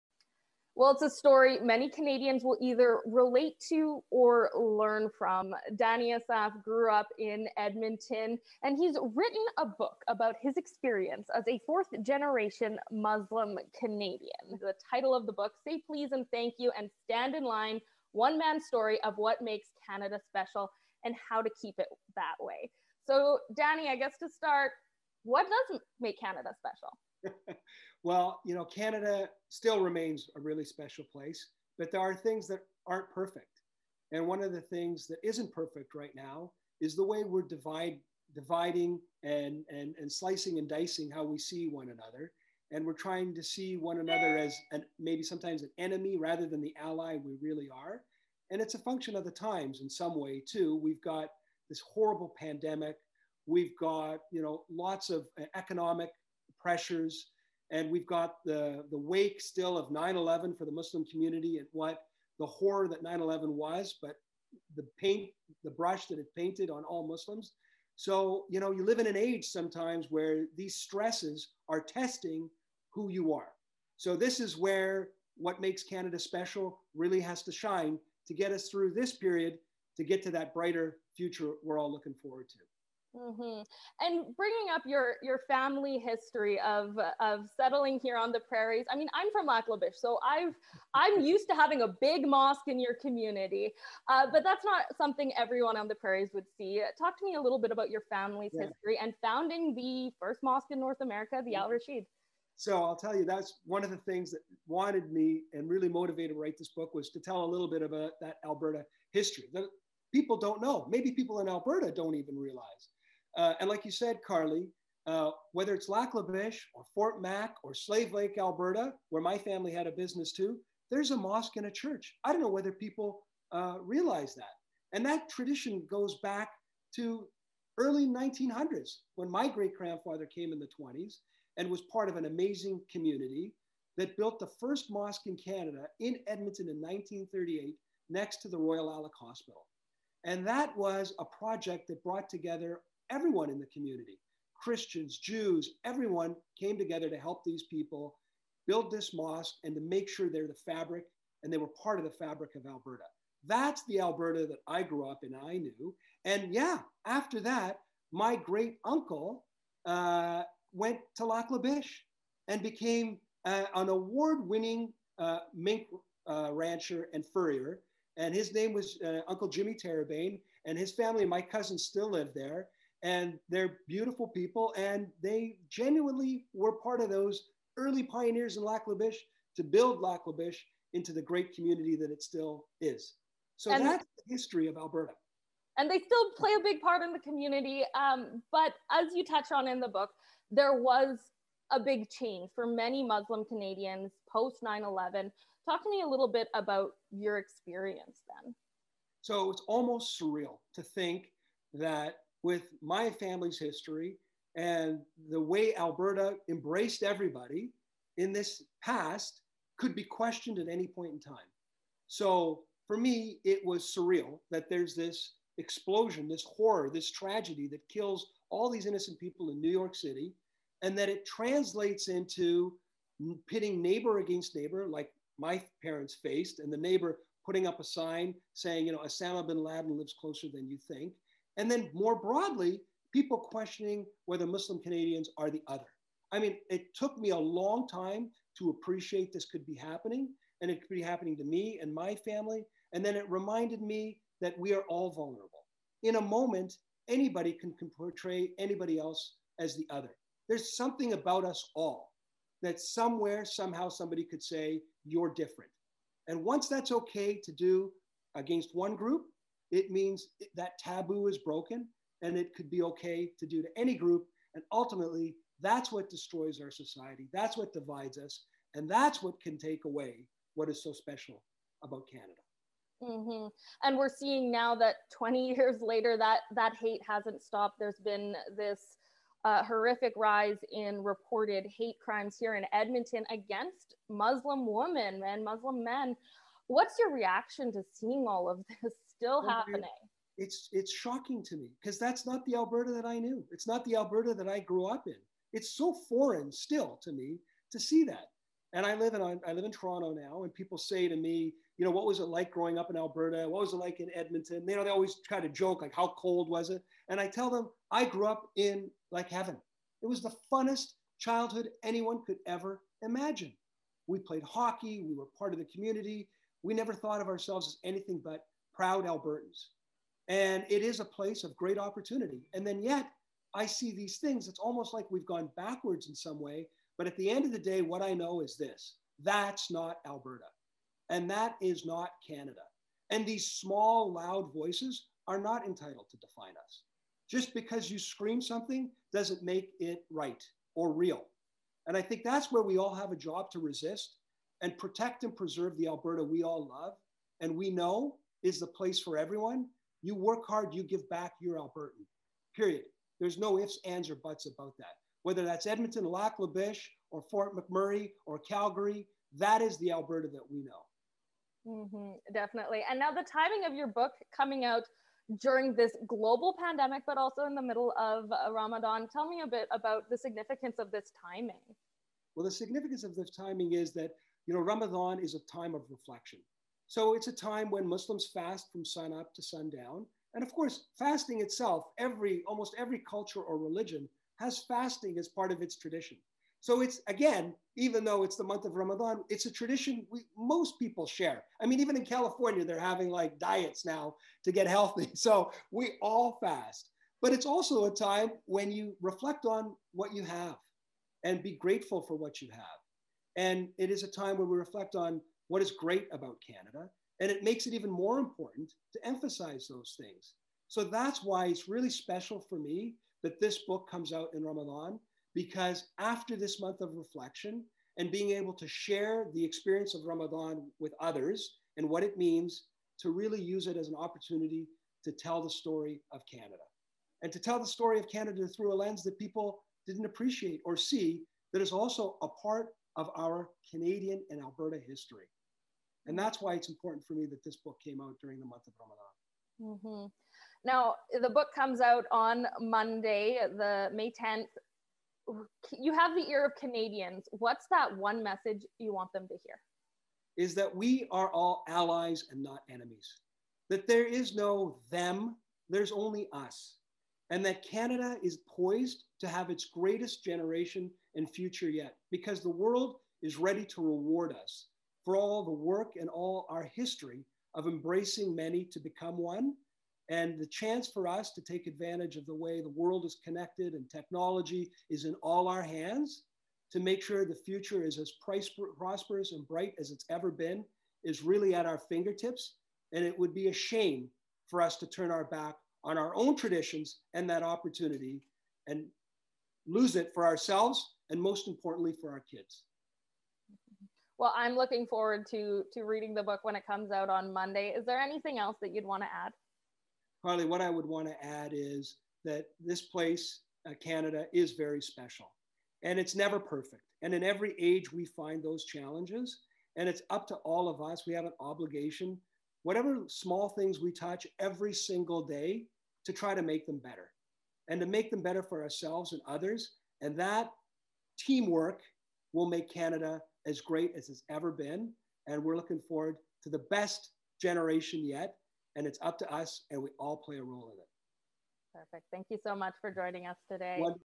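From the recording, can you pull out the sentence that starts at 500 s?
Carly, what I would want to add is that this place, uh, Canada, is very special and it's never perfect.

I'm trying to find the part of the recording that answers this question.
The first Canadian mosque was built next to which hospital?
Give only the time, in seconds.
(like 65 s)
138 s.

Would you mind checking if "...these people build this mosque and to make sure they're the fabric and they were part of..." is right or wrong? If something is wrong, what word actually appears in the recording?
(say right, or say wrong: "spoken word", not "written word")
right.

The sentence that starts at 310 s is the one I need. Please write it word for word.
It was the funnest childhood anyone could ever imagine.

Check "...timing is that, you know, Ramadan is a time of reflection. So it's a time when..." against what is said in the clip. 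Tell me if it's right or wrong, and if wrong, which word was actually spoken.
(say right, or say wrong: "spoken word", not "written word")
right.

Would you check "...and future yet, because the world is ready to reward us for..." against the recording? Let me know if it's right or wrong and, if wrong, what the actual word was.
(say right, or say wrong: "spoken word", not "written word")
right.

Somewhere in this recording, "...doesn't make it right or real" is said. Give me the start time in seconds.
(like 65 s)
339 s.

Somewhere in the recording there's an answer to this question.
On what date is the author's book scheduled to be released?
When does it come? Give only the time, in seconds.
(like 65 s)
443 s.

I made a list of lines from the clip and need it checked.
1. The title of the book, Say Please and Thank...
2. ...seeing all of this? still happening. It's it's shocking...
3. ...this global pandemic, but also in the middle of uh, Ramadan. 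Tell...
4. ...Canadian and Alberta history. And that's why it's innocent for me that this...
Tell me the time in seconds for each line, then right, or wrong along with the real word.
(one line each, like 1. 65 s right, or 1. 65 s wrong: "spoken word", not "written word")
1. 14 s right
2. 287 s right
3. 365 s right
4. 433 s wrong: "important", not "innocent".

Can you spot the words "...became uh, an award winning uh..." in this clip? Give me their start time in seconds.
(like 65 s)
162 s.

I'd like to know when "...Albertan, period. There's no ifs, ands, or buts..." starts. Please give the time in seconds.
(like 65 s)
351 s.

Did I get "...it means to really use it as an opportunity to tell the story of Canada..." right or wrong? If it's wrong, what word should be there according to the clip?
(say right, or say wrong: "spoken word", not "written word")
right.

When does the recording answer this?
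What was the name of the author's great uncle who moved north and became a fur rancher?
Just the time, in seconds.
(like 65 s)
169 s.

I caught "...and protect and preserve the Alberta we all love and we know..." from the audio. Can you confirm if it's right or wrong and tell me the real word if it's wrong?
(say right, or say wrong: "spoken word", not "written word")
right.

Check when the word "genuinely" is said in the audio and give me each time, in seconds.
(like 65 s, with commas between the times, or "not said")
175 s.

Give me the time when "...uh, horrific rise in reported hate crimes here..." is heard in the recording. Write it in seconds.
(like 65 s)
279 s.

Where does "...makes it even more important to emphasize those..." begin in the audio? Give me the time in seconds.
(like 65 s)
407 s.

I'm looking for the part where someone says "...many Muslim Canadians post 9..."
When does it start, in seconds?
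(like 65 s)
192 s.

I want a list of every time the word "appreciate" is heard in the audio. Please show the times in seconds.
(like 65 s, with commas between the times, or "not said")
238 s, 430 s.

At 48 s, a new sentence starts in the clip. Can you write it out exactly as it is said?
And it's a function of the times in some way, too.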